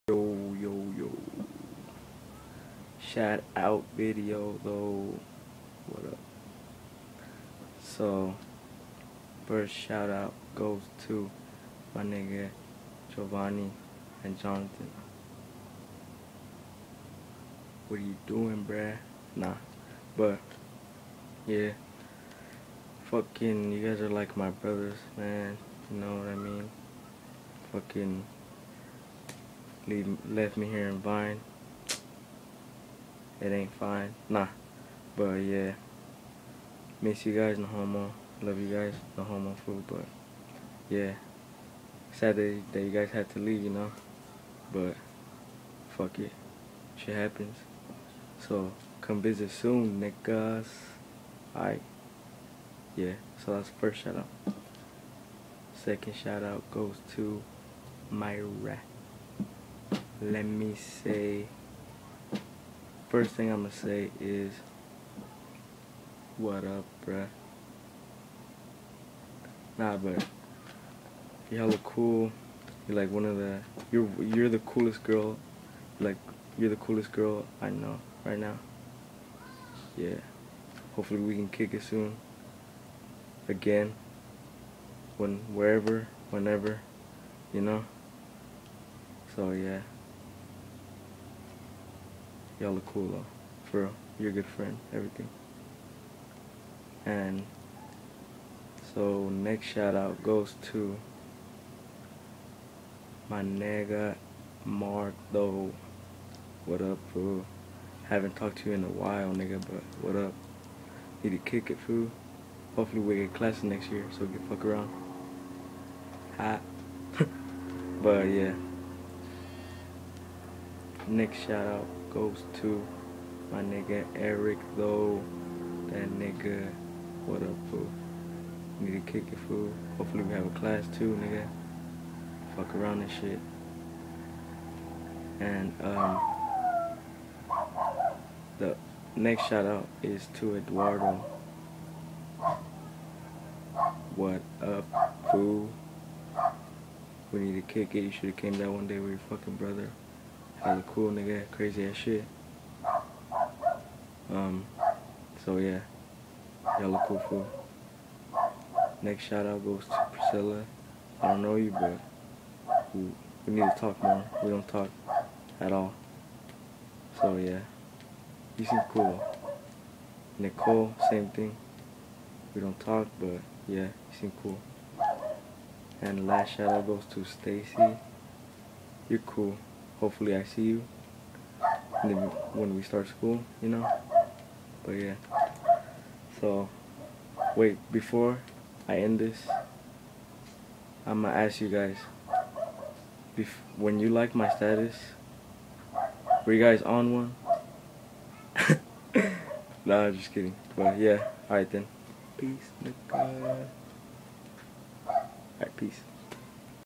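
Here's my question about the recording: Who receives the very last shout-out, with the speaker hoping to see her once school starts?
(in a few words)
Stacy.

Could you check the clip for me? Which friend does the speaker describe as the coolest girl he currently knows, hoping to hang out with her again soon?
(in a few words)
Mayra.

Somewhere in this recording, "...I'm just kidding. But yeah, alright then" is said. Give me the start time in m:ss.
3:20.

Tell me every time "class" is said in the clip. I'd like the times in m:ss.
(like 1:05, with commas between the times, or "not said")
1:53, 2:10.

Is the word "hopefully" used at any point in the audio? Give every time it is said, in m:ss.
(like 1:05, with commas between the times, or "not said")
1:20, 1:52, 2:09, 3:00.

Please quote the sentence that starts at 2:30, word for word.
He's a cool nigga, crazy as shit.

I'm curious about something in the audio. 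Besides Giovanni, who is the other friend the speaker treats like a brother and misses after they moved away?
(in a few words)
Jonathan.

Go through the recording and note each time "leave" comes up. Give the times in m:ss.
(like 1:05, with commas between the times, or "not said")
0:29, 0:43.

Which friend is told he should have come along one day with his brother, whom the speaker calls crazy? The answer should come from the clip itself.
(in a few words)
Eduardo.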